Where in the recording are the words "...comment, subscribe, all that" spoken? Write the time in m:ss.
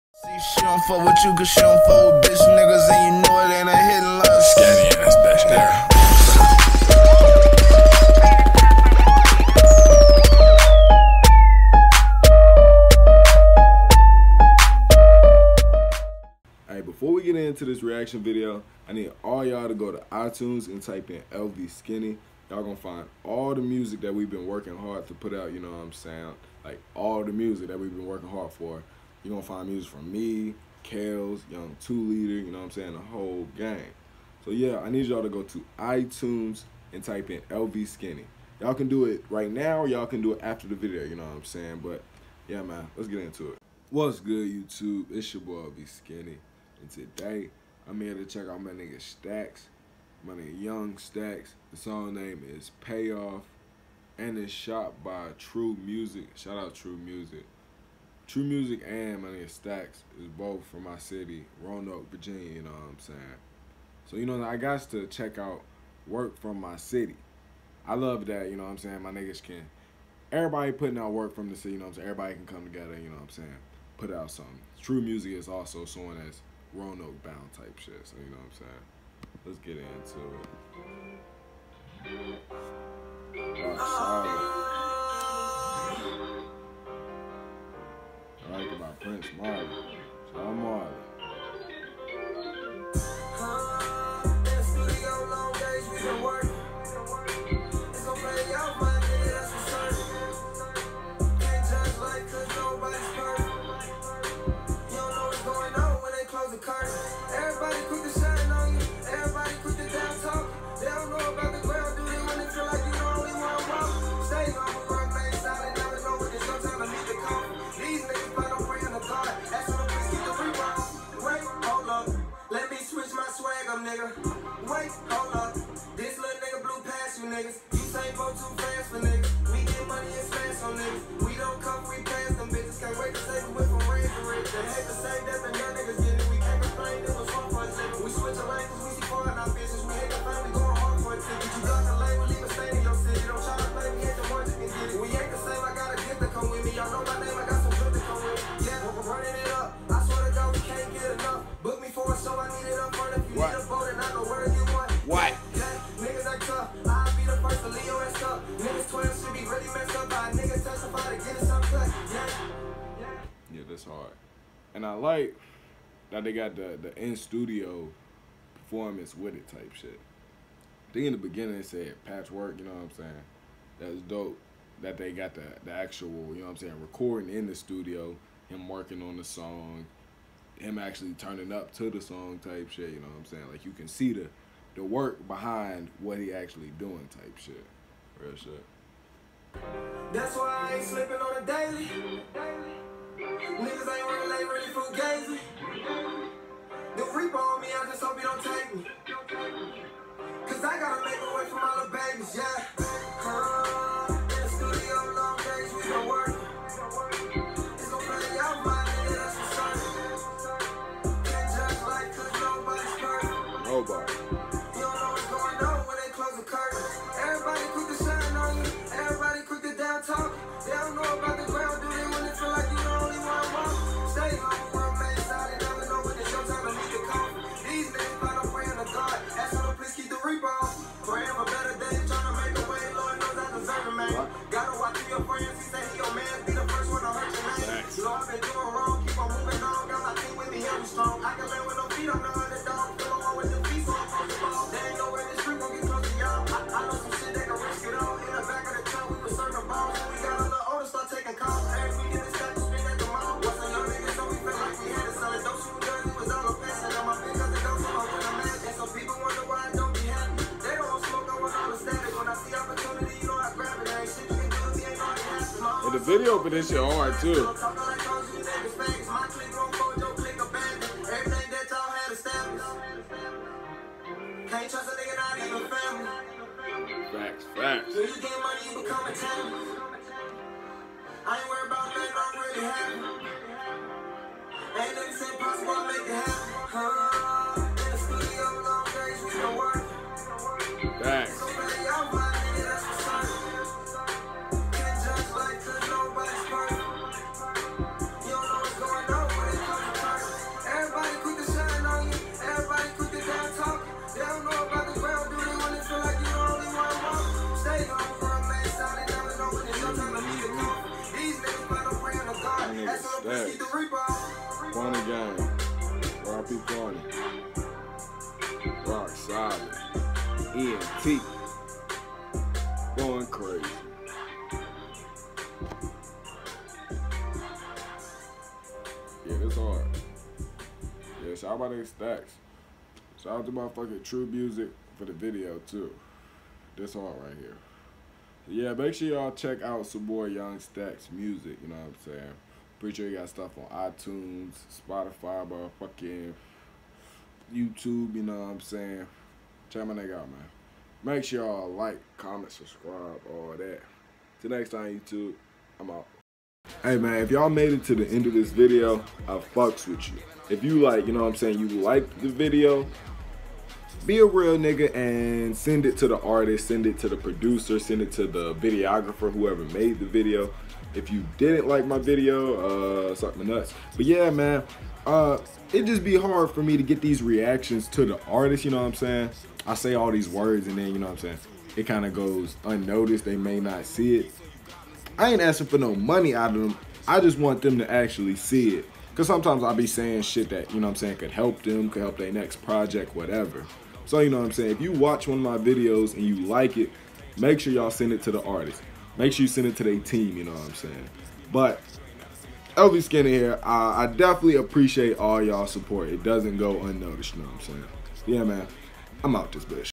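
5:52.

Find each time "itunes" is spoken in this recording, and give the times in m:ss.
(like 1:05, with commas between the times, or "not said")
0:20, 0:35, 5:43.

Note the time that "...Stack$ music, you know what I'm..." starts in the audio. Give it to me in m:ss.
5:40.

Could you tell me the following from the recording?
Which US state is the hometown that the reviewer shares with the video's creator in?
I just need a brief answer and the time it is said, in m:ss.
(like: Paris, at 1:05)
Virginia, at 1:02.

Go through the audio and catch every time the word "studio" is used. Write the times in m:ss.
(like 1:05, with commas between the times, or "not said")
2:47, 2:57.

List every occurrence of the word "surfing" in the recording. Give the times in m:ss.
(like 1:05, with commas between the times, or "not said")
not said.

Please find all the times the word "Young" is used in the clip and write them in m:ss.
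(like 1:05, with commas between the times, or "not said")
0:31.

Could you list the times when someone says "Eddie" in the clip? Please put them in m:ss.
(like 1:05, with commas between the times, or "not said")
not said.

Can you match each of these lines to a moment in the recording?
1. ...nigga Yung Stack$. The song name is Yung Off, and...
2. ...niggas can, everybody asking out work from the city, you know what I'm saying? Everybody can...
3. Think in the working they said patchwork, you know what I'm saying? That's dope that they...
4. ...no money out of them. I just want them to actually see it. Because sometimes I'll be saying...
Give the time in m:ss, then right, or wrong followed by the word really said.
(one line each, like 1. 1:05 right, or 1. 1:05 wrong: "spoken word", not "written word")
1. 0:50 wrong: "Pay", not "Yung"
2. 1:09 wrong: "putting", not "asking"
3. 2:50 wrong: "beginning", not "working"
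4. 6:25 right.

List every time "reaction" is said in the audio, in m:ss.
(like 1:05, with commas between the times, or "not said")
0:17, 6:17.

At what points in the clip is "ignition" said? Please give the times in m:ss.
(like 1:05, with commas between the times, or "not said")
not said.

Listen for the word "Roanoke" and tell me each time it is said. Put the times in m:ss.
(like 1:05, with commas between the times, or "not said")
1:01, 1:16.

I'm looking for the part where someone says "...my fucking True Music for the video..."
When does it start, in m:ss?
5:33.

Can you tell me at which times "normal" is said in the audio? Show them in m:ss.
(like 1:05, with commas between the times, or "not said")
not said.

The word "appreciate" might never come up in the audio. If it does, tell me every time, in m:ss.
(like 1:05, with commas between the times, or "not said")
6:44.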